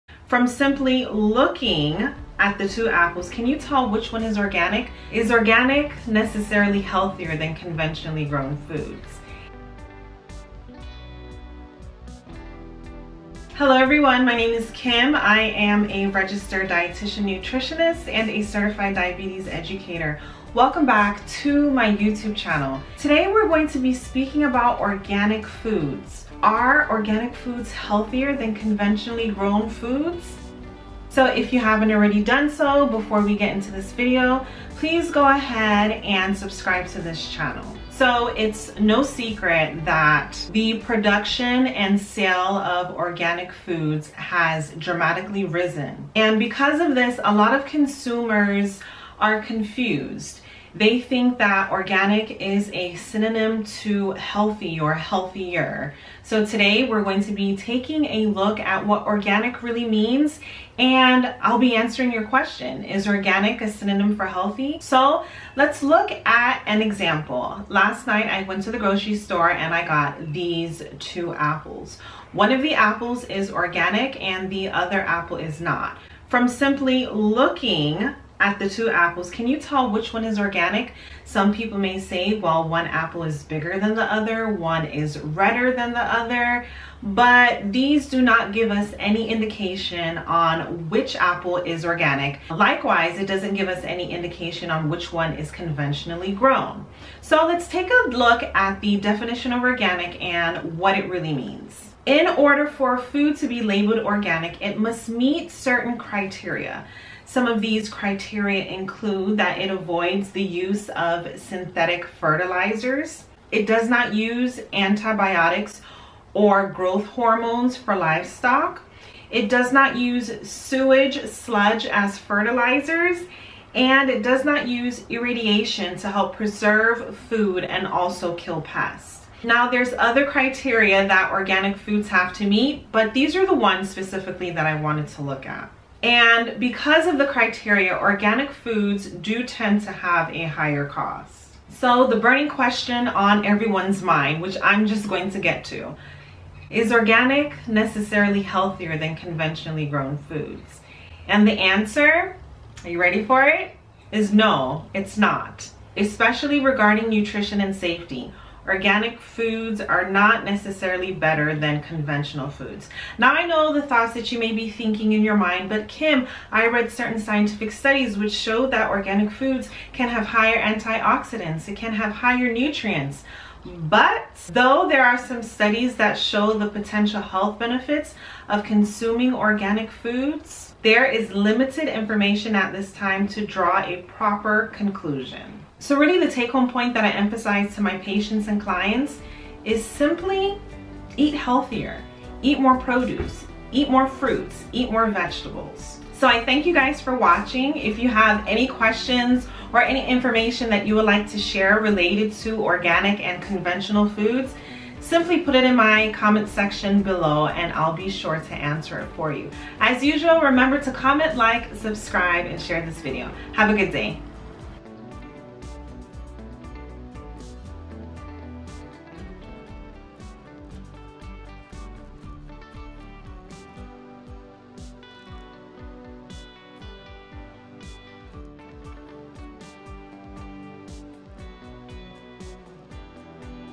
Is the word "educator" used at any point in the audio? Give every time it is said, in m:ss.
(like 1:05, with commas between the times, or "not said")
0:19.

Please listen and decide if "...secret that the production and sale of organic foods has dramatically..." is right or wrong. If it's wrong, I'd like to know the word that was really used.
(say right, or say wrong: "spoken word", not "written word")
right.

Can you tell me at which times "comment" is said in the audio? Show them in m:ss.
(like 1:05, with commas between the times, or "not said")
3:26, 3:30.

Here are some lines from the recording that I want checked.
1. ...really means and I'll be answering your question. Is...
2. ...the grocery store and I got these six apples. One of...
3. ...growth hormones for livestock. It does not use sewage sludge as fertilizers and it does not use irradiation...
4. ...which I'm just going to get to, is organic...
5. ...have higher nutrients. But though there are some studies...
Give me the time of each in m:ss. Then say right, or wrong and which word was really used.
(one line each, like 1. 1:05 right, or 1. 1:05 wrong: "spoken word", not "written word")
1. 0:59 right
2. 1:08 wrong: "two", not "six"
3. 1:56 right
4. 2:24 right
5. 2:51 right.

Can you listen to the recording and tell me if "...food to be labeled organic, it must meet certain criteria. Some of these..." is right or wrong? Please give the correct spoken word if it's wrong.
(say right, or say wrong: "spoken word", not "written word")
right.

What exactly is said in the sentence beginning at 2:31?
And the answer, are you ready for it?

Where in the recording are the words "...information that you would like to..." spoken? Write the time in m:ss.
3:20.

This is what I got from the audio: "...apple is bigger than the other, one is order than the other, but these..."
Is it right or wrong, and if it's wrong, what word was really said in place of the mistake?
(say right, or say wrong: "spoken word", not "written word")
wrong: "redder", not "order".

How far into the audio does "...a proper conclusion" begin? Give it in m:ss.
3:03.